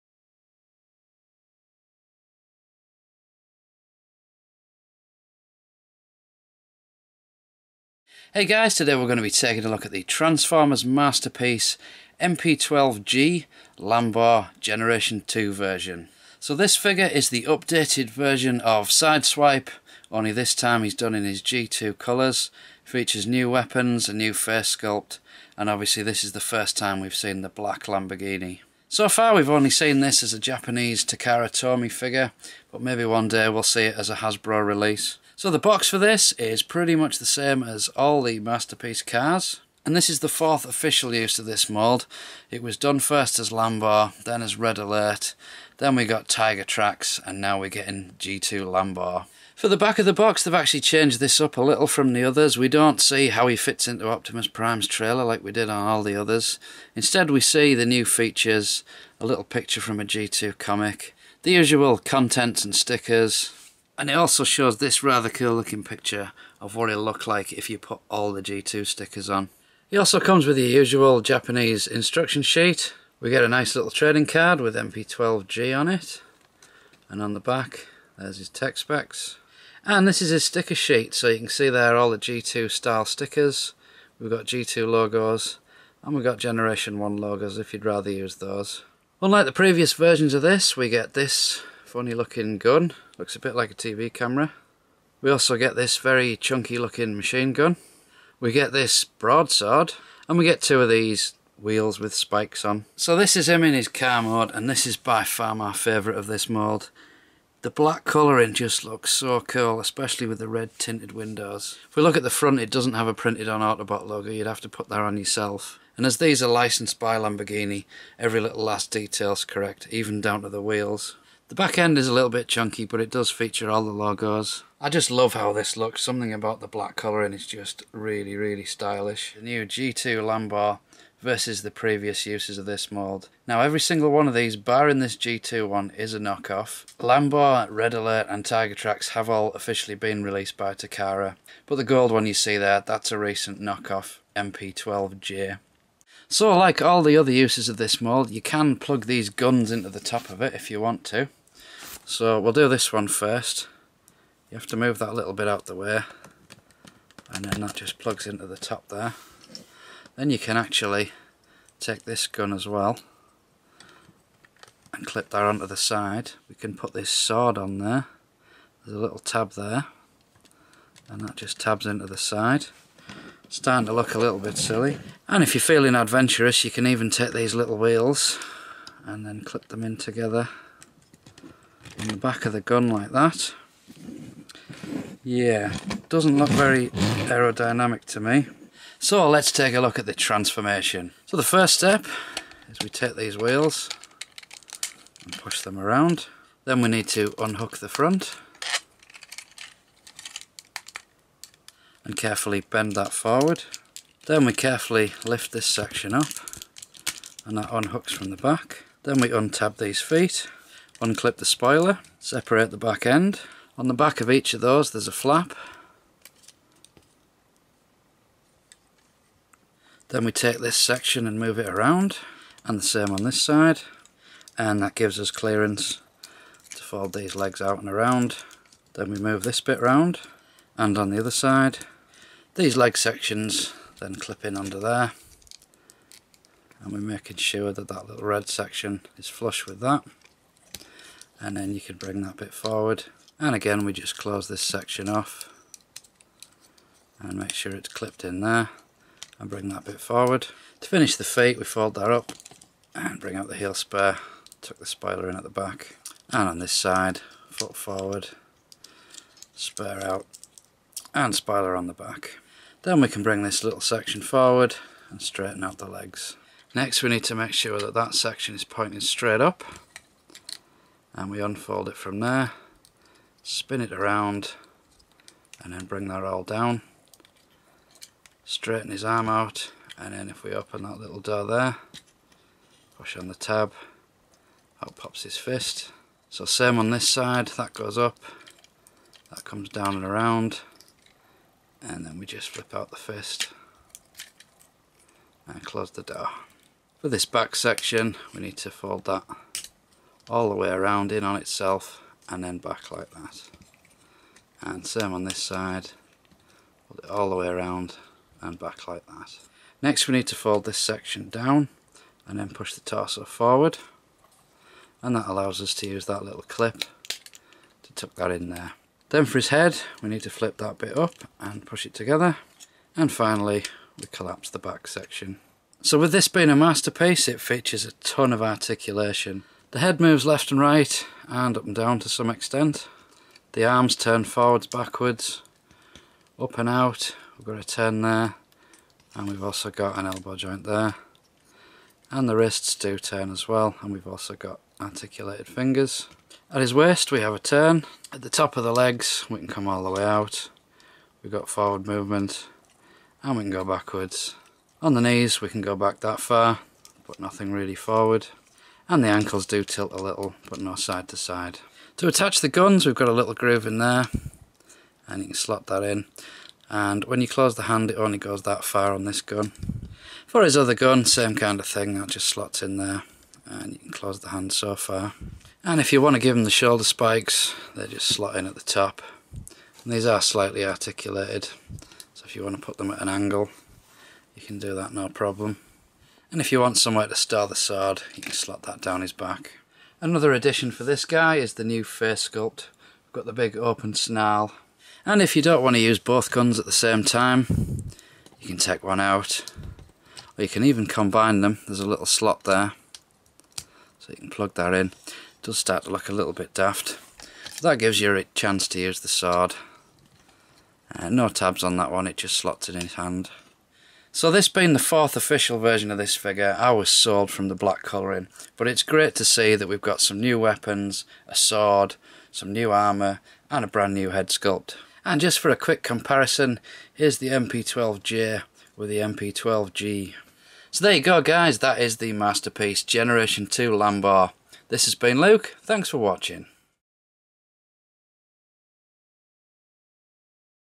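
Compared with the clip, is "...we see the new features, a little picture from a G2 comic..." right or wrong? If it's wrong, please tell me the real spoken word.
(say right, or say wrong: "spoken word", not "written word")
right.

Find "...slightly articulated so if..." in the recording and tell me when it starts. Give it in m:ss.
6:20.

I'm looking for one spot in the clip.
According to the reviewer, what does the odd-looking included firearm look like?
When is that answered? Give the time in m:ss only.
1:33.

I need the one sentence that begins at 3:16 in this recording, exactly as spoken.
Then we need to unhook the front and carefully bend that forward.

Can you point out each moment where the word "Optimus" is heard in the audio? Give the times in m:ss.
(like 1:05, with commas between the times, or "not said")
0:54.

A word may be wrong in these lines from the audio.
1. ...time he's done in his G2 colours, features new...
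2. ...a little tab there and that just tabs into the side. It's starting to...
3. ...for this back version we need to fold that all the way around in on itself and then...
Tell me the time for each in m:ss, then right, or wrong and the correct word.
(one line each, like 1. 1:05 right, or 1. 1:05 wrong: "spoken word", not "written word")
1. 0:20 right
2. 2:48 right
3. 4:57 wrong: "section", not "version".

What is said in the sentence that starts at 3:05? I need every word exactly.
Yeah, doesn't look very aerodynamic to me.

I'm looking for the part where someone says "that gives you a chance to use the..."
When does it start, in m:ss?
6:47.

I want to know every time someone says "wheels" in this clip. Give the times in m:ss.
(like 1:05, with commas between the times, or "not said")
1:41, 2:00, 2:57, 3:13.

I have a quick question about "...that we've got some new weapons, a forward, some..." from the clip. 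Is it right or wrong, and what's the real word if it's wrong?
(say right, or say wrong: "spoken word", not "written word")
wrong: "sword", not "forward".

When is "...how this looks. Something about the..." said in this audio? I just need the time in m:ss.
2:05.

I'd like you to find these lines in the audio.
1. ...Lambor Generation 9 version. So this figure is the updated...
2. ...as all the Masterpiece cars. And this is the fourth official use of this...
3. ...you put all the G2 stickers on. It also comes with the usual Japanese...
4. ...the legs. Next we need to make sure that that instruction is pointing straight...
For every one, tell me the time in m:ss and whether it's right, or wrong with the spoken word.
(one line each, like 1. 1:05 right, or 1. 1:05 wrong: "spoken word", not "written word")
1. 0:13 wrong: "2", not "9"
2. 0:37 right
3. 1:07 right
4. 4:25 wrong: "section", not "instruction".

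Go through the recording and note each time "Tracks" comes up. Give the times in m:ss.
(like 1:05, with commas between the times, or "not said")
0:46, 2:18.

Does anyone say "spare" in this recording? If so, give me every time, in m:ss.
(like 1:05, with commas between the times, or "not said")
4:13, 4:19.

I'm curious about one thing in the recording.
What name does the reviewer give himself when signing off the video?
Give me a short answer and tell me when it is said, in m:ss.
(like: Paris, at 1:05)
Luke, at 7:15.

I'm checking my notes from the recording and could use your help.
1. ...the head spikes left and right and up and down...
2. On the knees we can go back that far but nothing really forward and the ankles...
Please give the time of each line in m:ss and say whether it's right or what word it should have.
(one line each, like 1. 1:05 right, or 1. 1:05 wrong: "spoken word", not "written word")
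1. 5:29 wrong: "moves", not "spikes"
2. 5:54 right.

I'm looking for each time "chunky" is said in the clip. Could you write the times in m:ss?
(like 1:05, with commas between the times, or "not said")
1:36, 2:02.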